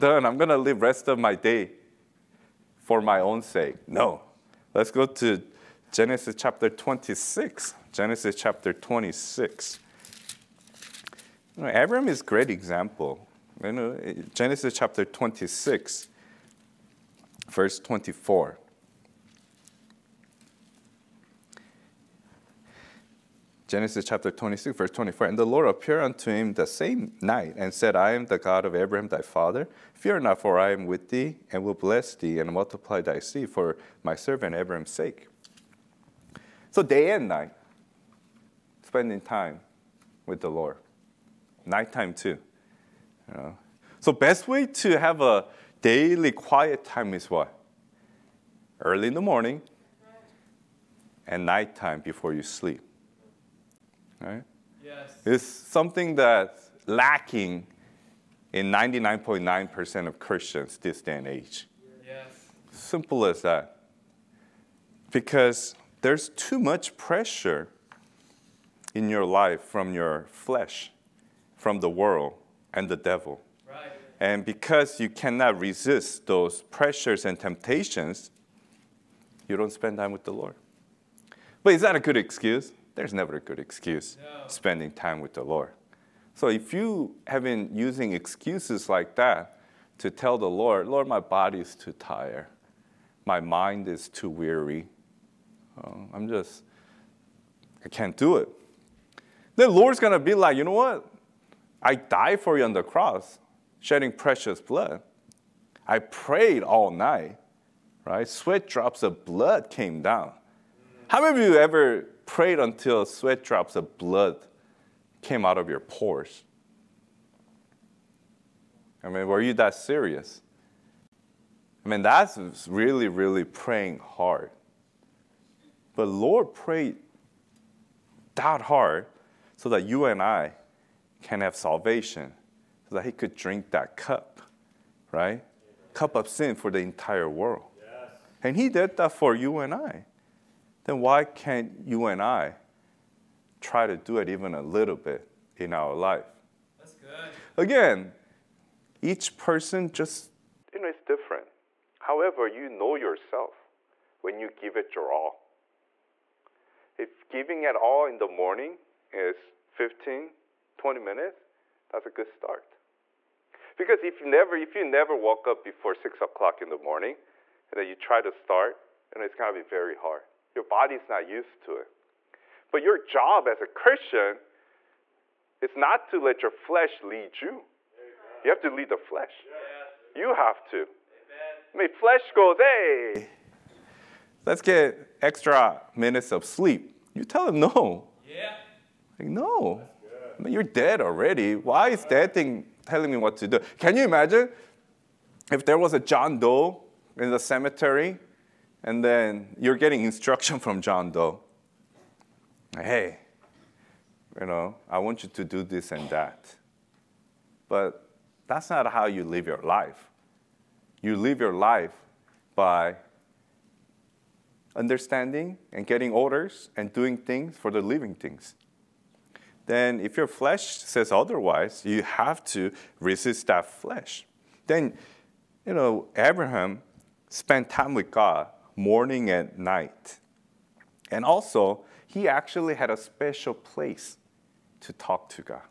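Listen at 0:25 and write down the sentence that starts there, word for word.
And the Lord appeared unto him the same night and said, I am the God of Abraham thy father.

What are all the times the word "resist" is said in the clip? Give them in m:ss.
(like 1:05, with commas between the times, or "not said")
1:15, 3:43.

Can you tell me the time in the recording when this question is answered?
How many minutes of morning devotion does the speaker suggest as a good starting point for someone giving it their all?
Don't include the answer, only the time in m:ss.
2:39.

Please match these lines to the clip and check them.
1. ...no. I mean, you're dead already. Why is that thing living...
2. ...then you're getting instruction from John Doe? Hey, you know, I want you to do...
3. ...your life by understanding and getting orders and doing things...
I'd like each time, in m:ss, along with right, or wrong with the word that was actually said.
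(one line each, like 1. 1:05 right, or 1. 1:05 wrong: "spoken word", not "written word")
1. 3:09 wrong: "telling", not "living"
2. 3:19 right
3. 3:31 right.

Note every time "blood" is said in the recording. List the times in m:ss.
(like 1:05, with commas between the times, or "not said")
1:44, 1:49, 1:53.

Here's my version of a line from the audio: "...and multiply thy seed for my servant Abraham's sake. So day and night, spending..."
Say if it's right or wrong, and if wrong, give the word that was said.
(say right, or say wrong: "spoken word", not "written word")
right.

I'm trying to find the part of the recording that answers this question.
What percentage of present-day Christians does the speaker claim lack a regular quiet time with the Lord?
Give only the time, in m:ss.
0:58.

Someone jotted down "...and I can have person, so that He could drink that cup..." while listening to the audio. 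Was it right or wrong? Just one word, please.
wrong.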